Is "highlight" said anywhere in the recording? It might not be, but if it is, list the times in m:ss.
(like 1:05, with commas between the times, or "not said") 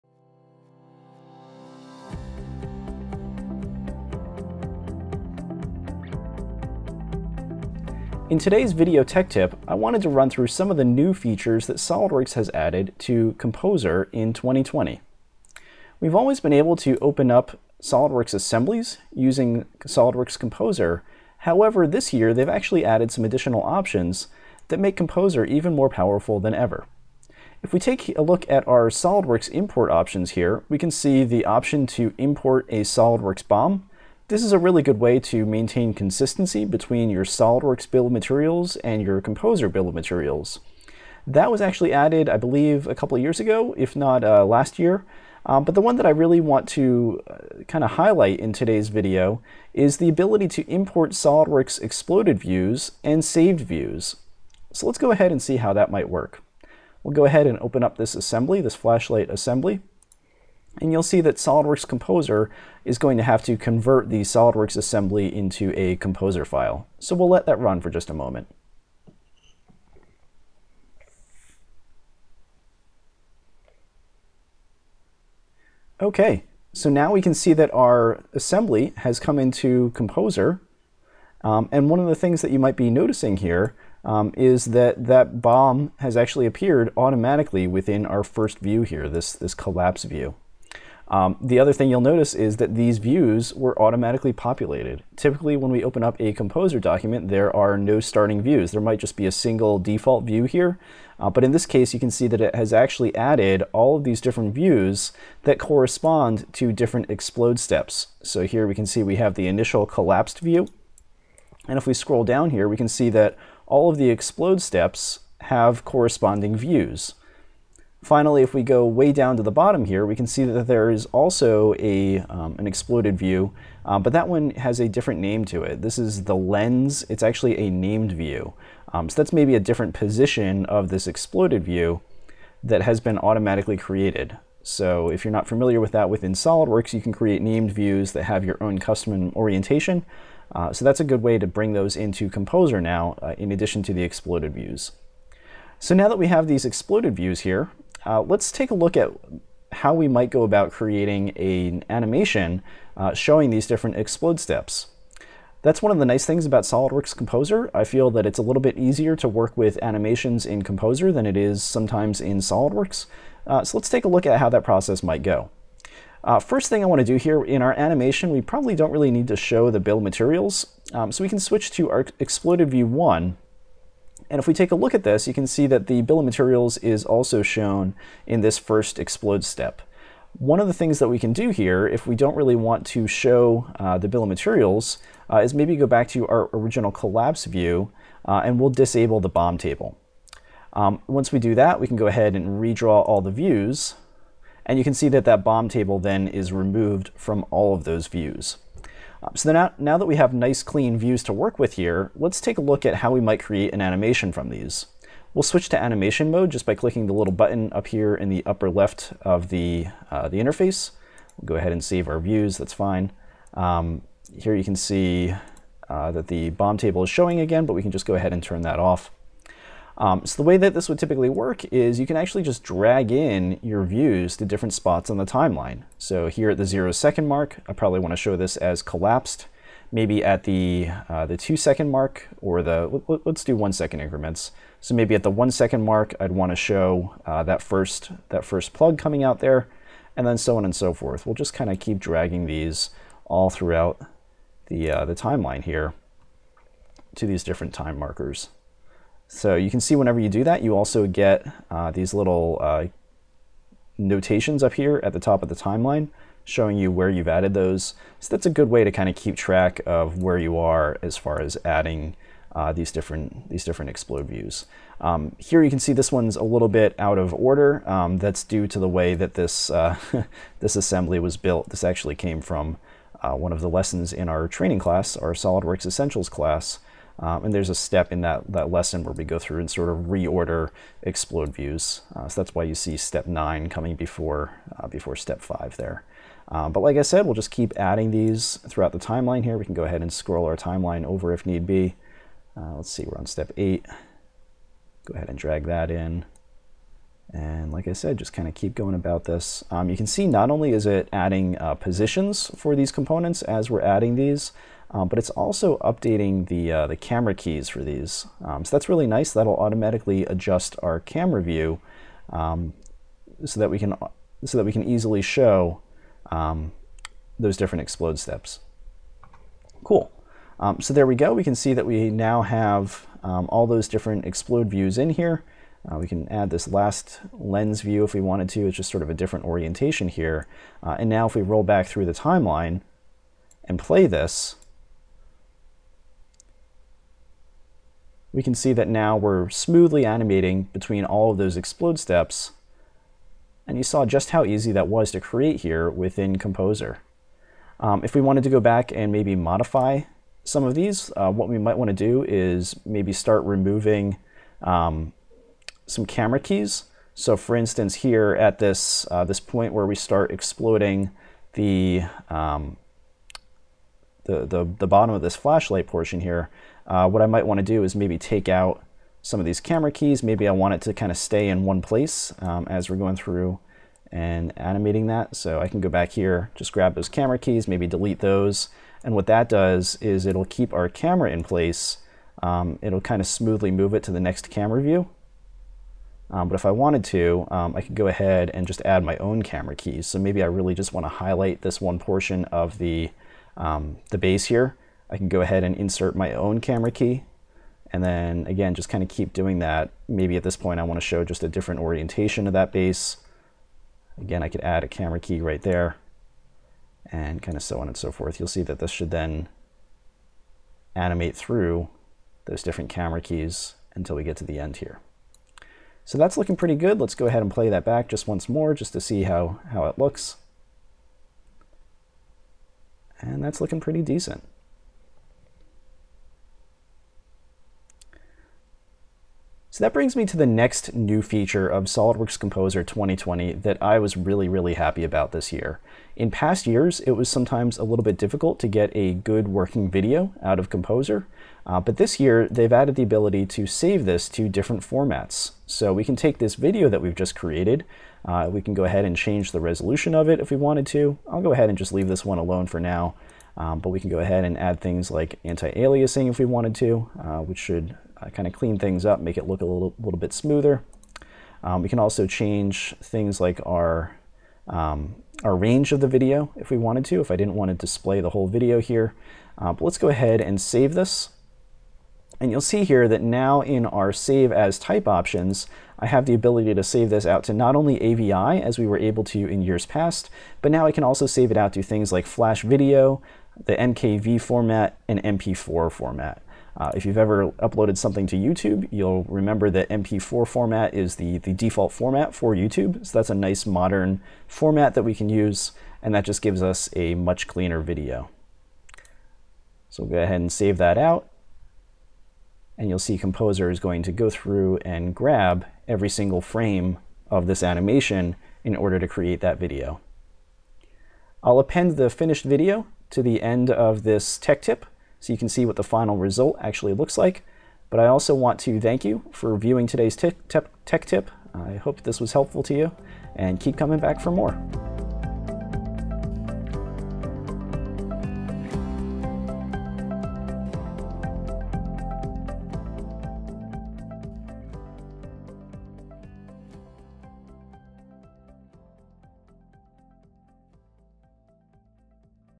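0:47, 6:31.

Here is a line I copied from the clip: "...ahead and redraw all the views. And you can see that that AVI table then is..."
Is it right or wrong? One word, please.
wrong.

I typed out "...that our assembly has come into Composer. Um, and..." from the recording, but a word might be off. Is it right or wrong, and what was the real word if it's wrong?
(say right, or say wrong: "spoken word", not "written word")
right.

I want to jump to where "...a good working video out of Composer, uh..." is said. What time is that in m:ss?
7:18.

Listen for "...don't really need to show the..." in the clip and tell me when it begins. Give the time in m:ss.
2:48.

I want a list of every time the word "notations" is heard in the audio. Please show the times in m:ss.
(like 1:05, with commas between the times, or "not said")
4:13.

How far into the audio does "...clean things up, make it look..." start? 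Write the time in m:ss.
7:38.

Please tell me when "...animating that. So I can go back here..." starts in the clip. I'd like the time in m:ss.
6:14.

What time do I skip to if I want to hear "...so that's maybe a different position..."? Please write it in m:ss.
2:09.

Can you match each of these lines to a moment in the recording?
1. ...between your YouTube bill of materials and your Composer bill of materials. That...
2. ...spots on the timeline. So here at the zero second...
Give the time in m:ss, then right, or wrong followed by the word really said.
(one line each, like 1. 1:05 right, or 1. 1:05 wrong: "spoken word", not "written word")
1. 0:36 wrong: "SOLIDWORKS", not "YouTube"
2. 3:44 right.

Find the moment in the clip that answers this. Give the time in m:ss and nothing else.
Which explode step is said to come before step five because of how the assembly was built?
4:42.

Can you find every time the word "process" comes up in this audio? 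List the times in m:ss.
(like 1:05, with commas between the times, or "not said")
2:44.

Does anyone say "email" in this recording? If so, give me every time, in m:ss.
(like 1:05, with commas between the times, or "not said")
not said.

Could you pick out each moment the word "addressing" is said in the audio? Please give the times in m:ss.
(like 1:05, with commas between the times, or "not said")
not said.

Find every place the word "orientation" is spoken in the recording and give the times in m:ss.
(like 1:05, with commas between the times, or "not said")
2:19, 5:29, 6:41.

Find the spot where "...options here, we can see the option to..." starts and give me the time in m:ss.
0:29.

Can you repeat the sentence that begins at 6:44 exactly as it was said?
Again, I could add a camera key right there and kind of so on and so forth.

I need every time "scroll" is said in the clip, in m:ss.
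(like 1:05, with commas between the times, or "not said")
1:51, 4:50.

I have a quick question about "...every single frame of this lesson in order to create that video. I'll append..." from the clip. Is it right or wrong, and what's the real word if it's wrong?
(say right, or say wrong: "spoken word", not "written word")
wrong: "animation", not "lesson".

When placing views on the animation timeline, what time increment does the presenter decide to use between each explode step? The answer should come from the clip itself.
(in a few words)
1 second.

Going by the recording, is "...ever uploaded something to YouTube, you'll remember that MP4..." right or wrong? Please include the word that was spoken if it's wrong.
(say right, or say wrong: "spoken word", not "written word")
right.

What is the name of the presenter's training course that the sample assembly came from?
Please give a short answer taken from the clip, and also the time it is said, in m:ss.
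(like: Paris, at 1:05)
SolidWorks Essentials, at 4:35.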